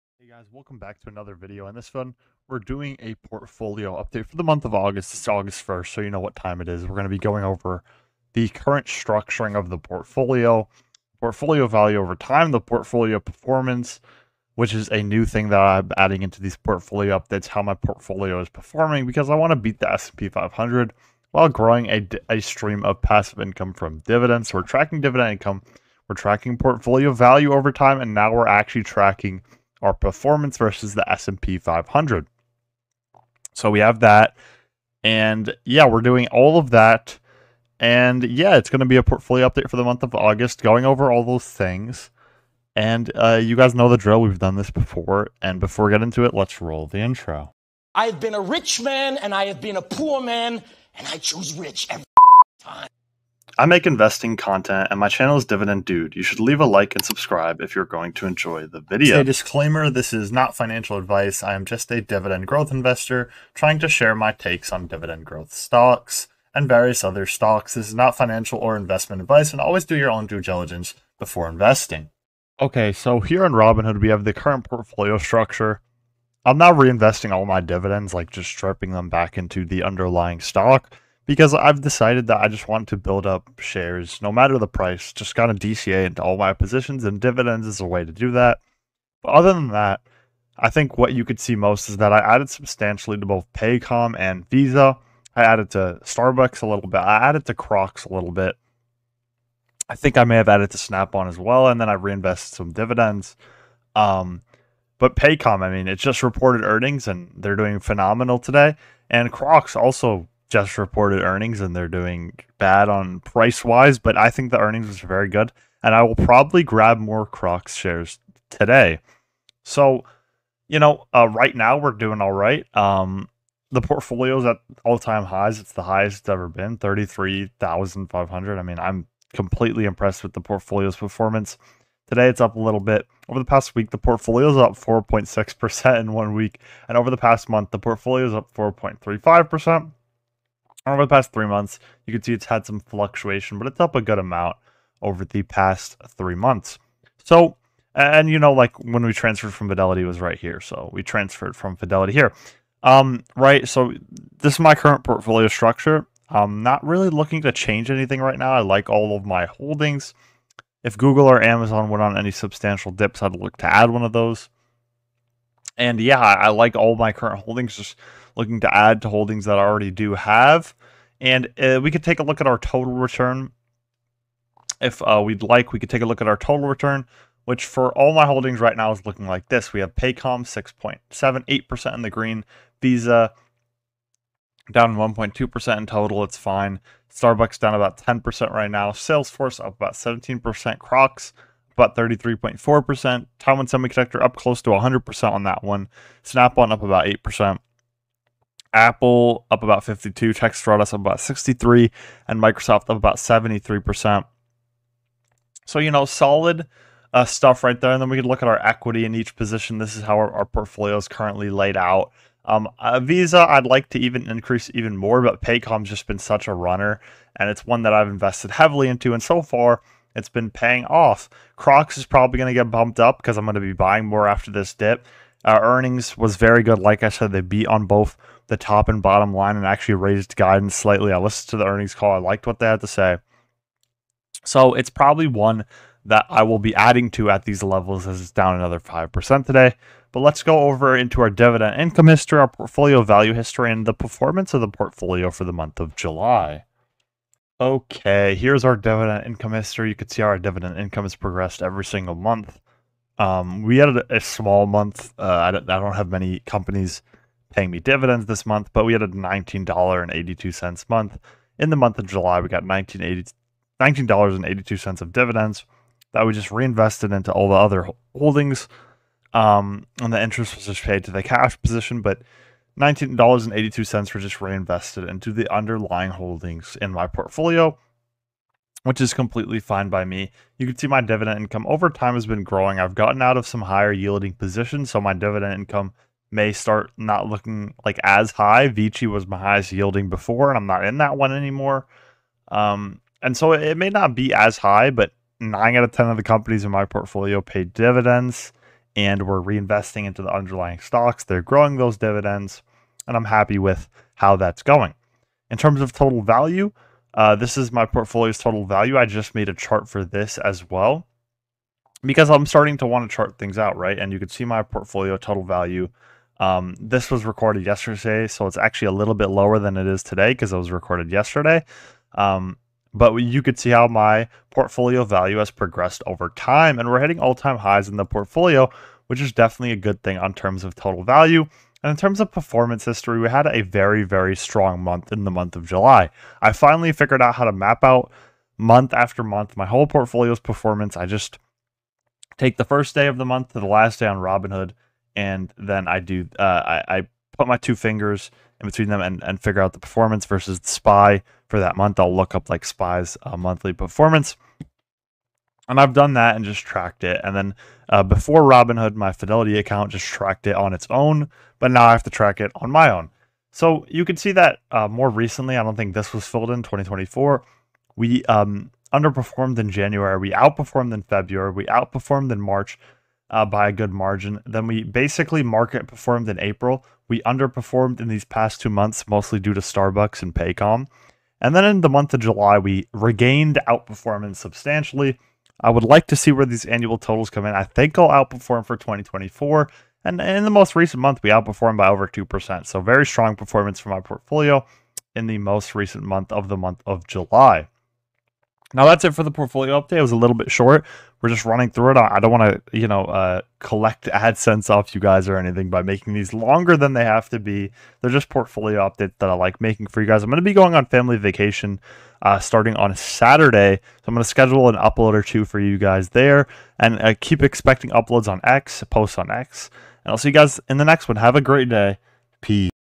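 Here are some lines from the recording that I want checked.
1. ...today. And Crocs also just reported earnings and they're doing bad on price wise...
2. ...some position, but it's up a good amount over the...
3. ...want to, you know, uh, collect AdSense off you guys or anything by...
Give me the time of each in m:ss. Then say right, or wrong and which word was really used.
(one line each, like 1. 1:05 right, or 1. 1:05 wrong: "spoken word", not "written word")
1. 1:48 right
2. 2:22 wrong: "fluctuation", not "position"
3. 6:42 right.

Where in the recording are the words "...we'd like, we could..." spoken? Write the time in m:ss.
2:55.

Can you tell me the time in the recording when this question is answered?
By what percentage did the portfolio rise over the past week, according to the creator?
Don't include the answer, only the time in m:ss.
2:14.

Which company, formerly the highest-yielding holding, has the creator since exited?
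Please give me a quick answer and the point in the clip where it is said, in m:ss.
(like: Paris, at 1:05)
Vici, at 4:48.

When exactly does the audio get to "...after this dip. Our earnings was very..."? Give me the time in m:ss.
3:44.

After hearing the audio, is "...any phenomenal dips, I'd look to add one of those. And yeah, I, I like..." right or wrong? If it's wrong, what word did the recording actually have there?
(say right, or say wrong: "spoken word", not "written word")
wrong: "substantial", not "phenomenal".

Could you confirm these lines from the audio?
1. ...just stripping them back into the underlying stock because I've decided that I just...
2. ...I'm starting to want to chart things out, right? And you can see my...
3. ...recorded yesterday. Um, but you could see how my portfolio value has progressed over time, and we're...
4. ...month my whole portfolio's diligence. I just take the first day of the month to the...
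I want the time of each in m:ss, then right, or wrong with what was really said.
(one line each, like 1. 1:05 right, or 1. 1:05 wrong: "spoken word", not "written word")
1. 1:18 right
2. 5:12 right
3. 5:20 right
4. 5:39 wrong: "performance", not "diligence".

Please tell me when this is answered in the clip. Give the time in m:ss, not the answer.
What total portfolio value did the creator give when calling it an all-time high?
2:06.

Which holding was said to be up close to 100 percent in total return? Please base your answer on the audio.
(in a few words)
Taiwan Semiconductor.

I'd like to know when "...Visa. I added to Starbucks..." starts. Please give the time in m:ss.
1:34.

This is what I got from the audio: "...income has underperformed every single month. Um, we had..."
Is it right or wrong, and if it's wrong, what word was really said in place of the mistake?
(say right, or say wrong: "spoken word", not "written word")
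wrong: "progressed", not "underperformed".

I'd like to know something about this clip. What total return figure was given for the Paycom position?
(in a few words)
6.78%.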